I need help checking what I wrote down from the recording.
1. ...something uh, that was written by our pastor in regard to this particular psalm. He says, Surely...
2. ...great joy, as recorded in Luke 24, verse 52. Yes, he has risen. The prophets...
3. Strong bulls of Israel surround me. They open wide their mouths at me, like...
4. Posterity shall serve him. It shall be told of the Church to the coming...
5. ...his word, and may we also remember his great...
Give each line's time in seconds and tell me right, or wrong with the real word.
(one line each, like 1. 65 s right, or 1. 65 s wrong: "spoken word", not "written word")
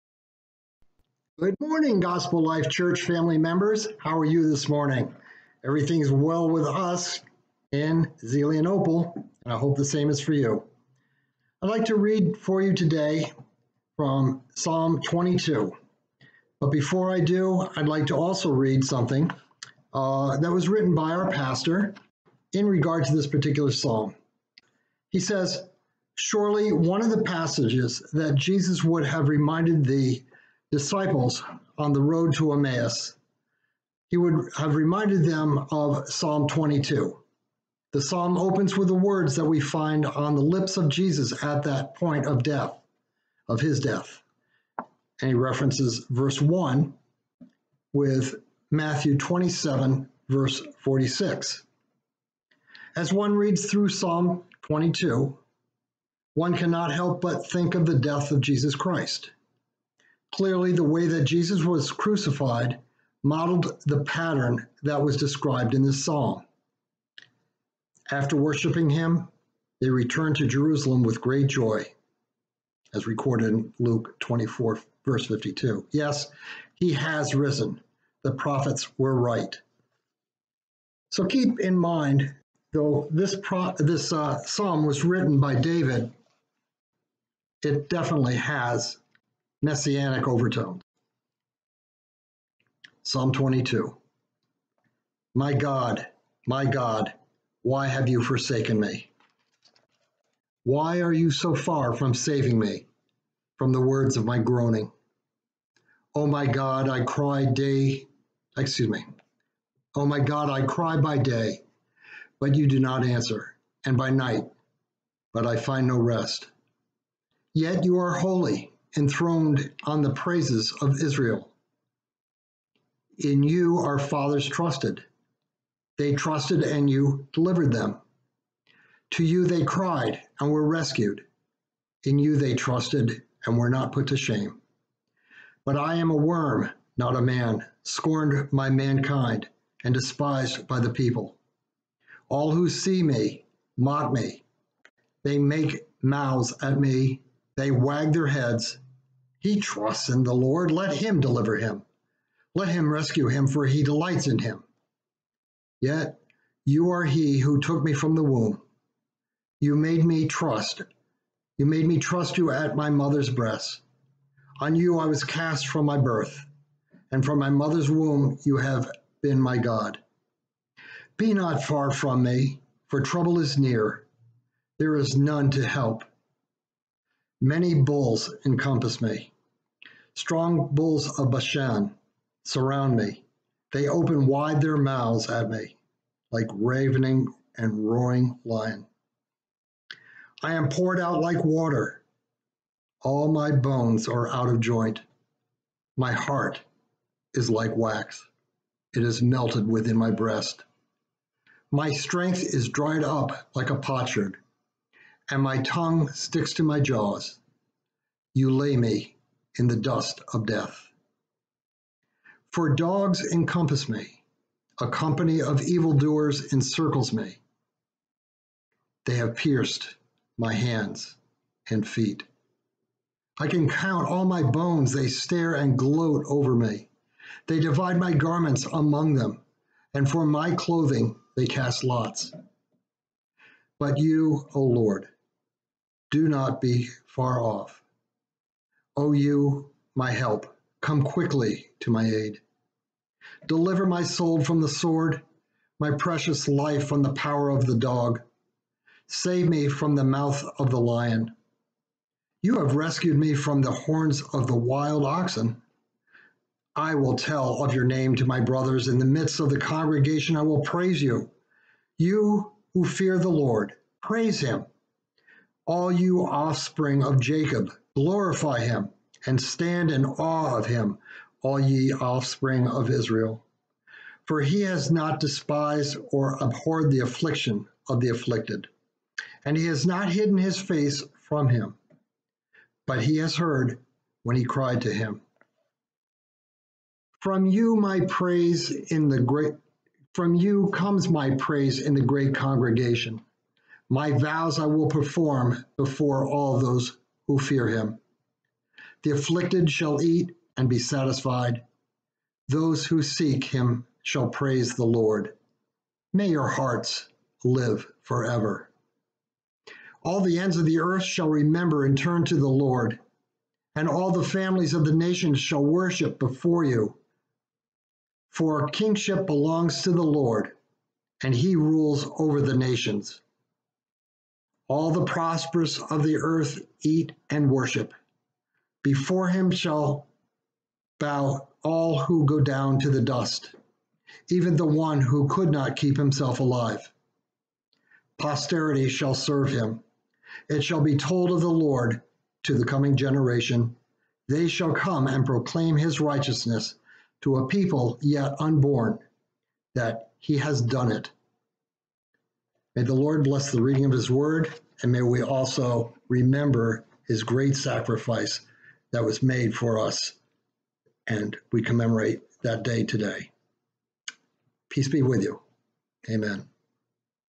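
1. 18 s right
2. 71 s right
3. 180 s wrong: "Bashan", not "Israel"
4. 338 s wrong: "Lord", not "Church"
5. 353 s right.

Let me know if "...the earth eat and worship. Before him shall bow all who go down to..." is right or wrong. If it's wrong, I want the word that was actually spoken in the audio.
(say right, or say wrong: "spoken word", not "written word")
right.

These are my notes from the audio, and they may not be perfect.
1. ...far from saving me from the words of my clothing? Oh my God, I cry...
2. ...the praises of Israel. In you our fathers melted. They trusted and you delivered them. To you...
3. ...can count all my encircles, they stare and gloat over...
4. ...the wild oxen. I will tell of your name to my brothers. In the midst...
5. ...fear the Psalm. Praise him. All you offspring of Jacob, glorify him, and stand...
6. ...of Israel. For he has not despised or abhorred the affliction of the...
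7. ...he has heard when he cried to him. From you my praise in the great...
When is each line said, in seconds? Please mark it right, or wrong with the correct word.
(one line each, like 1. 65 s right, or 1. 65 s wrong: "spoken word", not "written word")
1. 101 s wrong: "groaning", not "clothing"
2. 120 s wrong: "trusted", not "melted"
3. 223 s wrong: "bones", not "encircles"
4. 254 s right
5. 262 s wrong: "Lord", not "Psalm"
6. 272 s right
7. 283 s right.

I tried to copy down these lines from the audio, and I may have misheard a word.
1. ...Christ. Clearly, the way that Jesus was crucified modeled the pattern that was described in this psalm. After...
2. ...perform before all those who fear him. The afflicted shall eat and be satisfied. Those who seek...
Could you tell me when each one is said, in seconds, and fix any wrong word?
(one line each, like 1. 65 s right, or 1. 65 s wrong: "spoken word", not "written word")
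1. 58 s right
2. 294 s right.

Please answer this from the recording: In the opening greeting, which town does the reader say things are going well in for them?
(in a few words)
Zelienople.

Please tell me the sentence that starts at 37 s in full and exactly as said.
The psalm opens with the words that we find on the lips of Jesus at that point of death, of his death.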